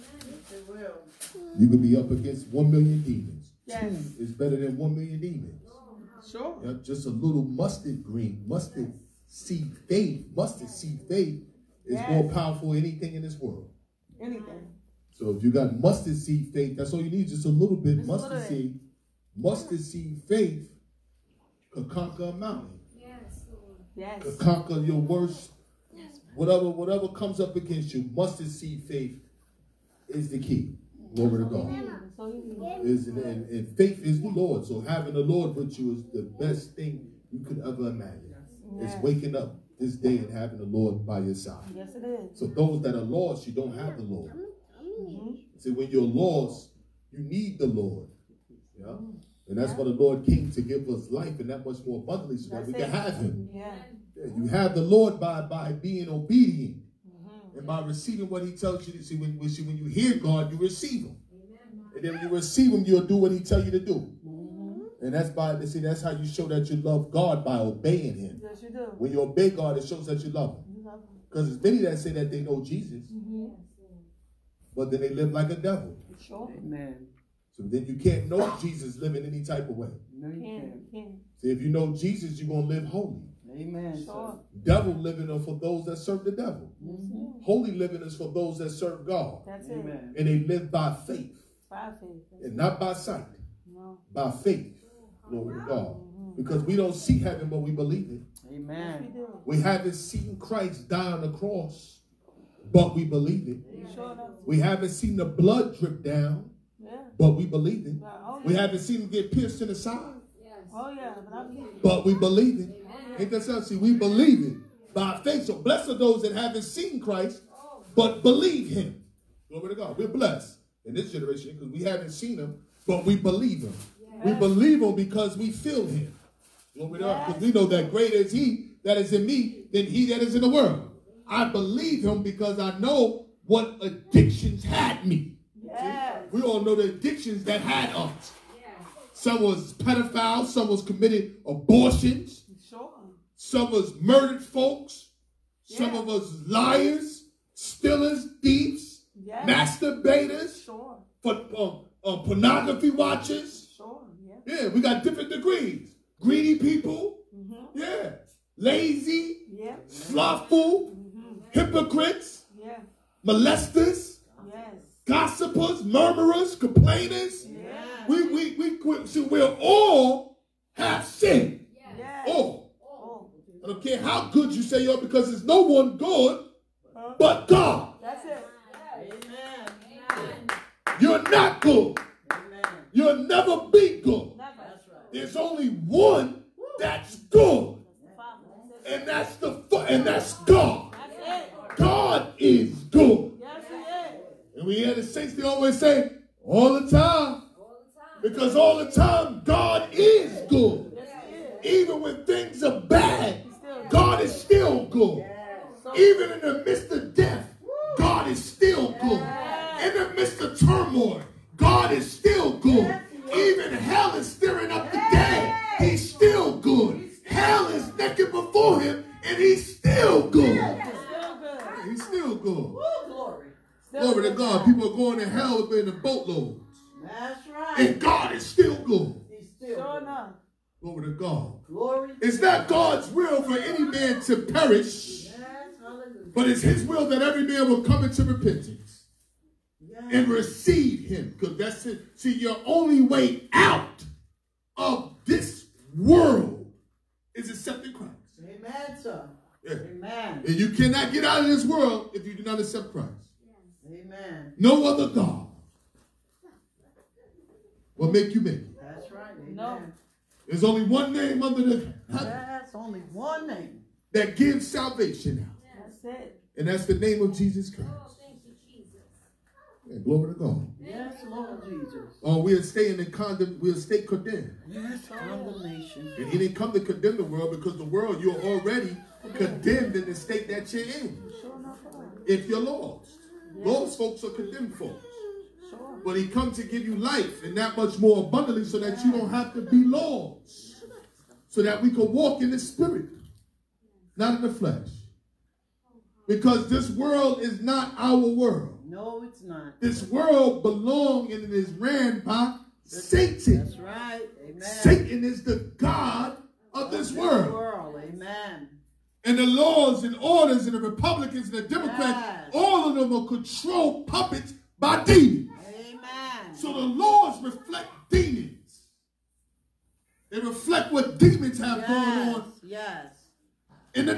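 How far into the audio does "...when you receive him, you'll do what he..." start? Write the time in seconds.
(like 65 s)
62 s.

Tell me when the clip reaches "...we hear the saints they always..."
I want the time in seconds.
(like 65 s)
194 s.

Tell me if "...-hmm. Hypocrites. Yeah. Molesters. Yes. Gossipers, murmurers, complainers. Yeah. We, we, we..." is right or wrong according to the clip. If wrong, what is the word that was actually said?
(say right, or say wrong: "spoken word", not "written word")
right.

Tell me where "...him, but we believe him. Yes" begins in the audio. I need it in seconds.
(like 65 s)
122 s.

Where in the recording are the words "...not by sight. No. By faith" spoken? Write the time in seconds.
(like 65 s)
92 s.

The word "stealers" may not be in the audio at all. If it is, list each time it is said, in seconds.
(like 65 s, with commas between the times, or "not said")
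147 s.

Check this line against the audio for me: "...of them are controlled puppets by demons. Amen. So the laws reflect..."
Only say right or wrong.
right.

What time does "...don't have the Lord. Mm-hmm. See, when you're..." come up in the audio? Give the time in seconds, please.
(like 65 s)
43 s.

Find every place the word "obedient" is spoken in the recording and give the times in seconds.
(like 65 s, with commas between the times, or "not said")
56 s.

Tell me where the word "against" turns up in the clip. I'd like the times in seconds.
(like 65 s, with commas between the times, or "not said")
2 s, 27 s.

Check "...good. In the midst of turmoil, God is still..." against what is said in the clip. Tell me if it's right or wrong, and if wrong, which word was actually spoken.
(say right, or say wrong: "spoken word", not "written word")
right.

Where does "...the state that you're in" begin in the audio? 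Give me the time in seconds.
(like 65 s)
280 s.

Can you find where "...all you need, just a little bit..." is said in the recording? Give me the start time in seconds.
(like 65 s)
16 s.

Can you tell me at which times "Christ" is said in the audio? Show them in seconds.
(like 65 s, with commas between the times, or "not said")
100 s, 116 s, 247 s, 252 s, 267 s.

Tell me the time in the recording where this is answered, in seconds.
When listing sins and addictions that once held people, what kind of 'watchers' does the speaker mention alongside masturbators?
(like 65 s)
152 s.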